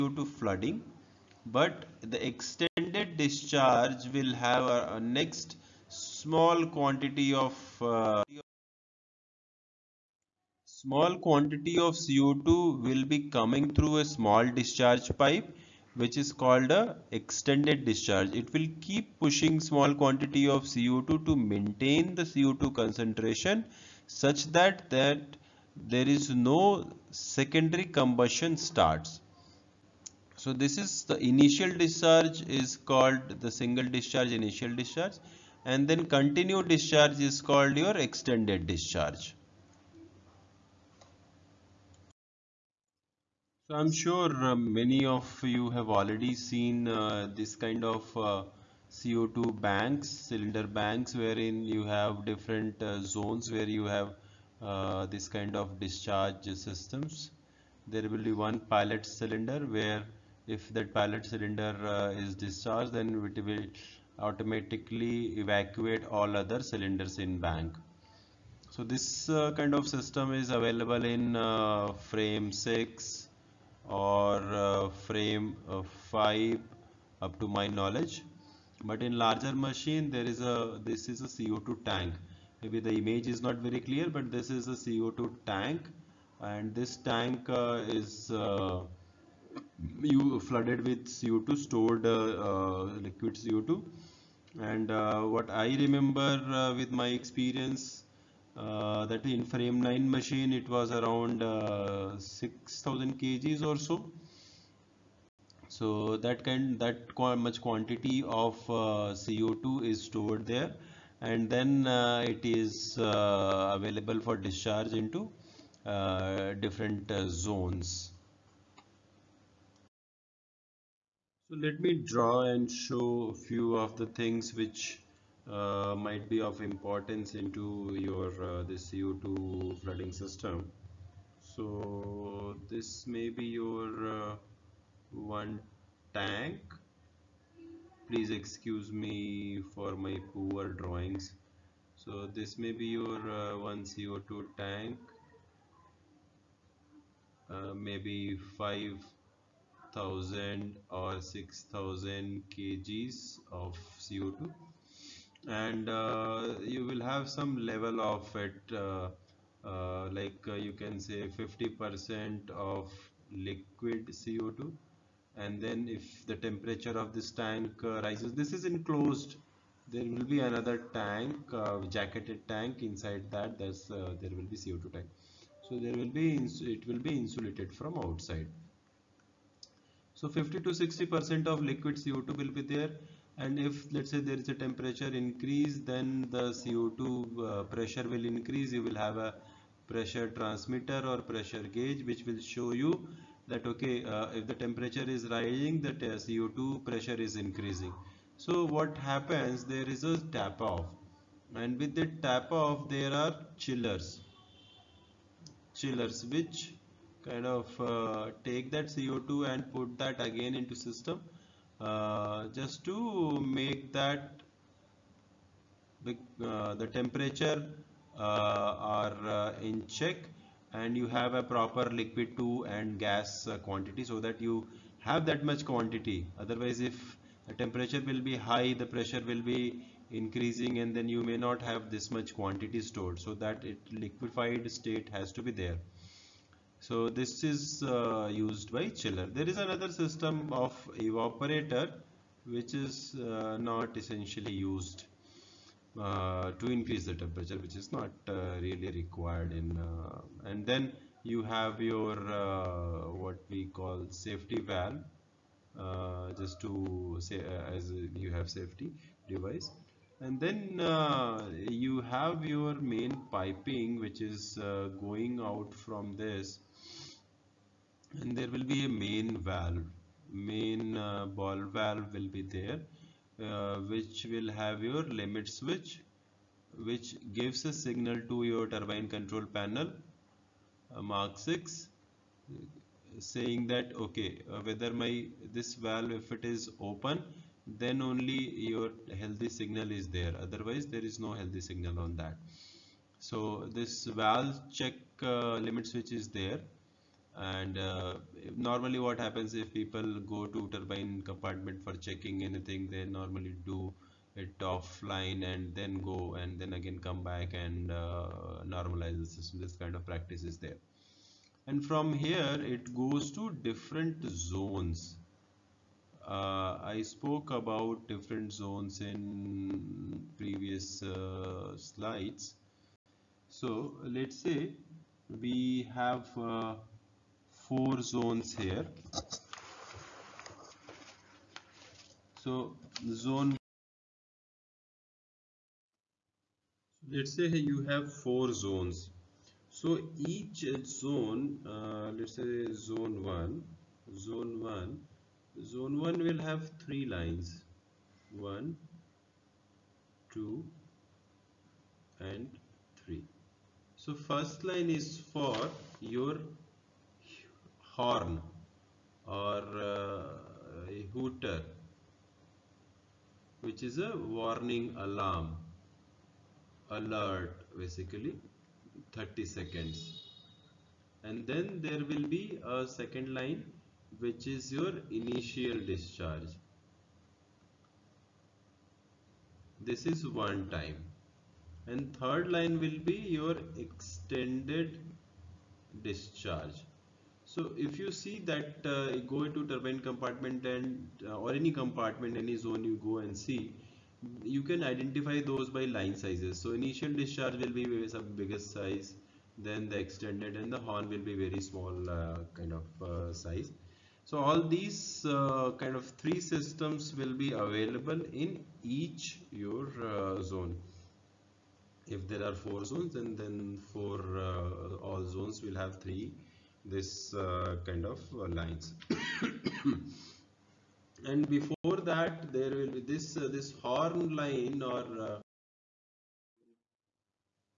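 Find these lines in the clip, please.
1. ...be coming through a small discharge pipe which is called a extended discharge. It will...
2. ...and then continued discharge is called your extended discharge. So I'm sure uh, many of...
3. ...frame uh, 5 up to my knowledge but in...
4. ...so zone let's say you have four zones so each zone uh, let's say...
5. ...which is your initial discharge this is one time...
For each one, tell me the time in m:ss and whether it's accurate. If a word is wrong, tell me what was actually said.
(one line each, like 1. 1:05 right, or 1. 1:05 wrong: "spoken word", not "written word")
1. 0:13 right
2. 0:35 right
3. 1:15 right
4. 5:32 right
5. 6:14 right.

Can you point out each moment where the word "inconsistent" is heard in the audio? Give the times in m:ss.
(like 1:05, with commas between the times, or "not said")
not said.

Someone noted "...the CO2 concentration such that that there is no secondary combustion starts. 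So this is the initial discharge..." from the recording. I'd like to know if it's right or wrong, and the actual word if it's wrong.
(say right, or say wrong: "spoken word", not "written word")
right.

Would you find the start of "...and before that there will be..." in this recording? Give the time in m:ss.
7:01.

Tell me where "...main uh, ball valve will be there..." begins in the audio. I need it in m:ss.
4:30.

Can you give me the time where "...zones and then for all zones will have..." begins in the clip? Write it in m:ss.
6:52.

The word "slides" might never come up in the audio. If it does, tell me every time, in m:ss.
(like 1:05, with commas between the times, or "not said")
5:21.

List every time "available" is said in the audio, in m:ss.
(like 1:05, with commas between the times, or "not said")
1:10, 1:53, 6:47.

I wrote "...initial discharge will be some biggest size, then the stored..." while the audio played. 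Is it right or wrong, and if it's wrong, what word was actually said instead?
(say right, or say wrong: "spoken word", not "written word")
wrong: "extended", not "stored".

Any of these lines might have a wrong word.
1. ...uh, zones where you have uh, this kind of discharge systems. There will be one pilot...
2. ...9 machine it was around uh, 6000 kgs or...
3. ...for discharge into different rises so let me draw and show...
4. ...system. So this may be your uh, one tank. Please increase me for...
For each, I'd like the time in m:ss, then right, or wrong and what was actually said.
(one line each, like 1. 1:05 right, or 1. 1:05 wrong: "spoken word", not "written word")
1. 0:52 right
2. 1:39 right
3. 1:54 wrong: "zones", not "rises"
4. 2:10 wrong: "excuse", not "increase".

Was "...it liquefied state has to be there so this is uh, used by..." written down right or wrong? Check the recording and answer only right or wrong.
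right.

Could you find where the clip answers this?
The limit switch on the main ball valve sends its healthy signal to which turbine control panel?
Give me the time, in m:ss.
4:41.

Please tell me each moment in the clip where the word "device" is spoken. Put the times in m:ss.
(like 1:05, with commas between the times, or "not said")
4:19.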